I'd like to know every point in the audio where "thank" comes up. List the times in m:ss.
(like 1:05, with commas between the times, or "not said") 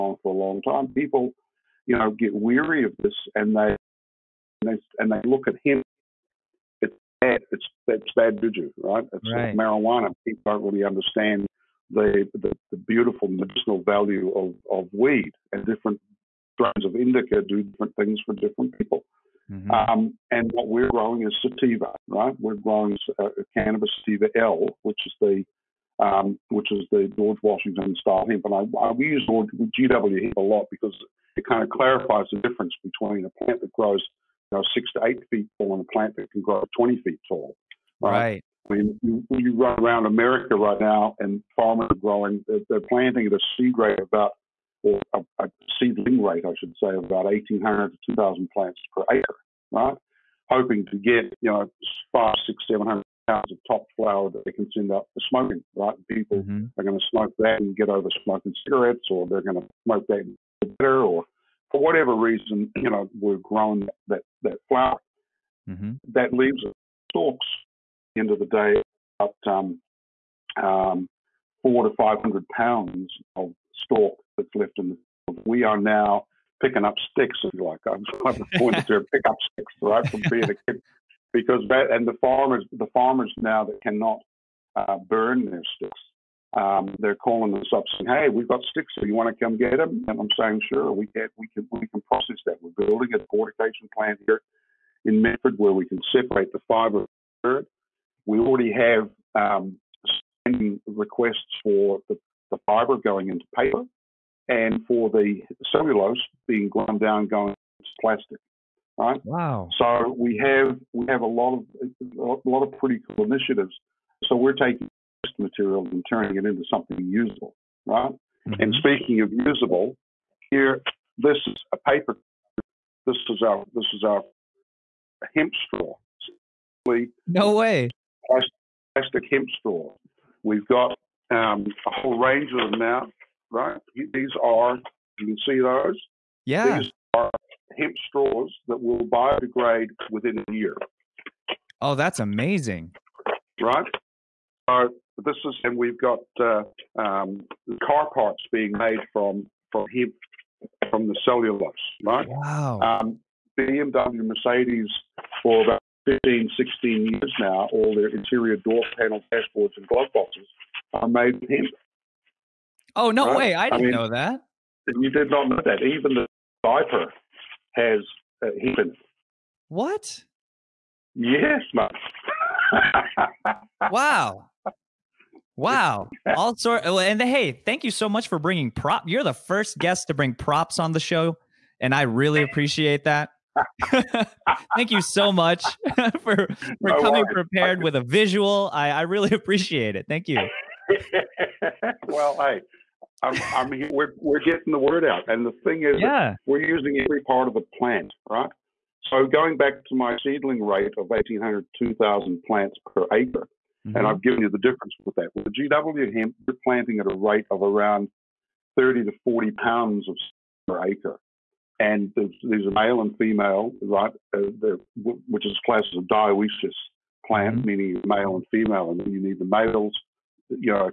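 2:57, 3:04, 3:10.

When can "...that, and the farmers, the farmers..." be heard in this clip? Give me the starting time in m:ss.
1:21.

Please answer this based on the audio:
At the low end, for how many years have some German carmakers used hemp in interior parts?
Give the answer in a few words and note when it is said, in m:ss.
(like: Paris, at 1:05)
15, at 2:36.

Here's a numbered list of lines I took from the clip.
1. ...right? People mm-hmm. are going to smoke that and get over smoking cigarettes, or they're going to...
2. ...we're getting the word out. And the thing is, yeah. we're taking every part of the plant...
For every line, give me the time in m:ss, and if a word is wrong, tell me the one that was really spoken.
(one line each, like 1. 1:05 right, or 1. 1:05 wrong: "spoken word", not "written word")
1. 0:55 right
2. 3:14 wrong: "using", not "taking".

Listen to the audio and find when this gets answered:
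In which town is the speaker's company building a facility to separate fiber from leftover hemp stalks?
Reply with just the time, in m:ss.
1:35.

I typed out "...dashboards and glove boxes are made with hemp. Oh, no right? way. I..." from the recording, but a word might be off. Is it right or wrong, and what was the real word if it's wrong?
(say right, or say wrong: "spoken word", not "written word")
right.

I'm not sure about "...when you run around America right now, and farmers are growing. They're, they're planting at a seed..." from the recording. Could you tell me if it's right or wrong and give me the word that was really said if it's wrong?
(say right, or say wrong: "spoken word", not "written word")
right.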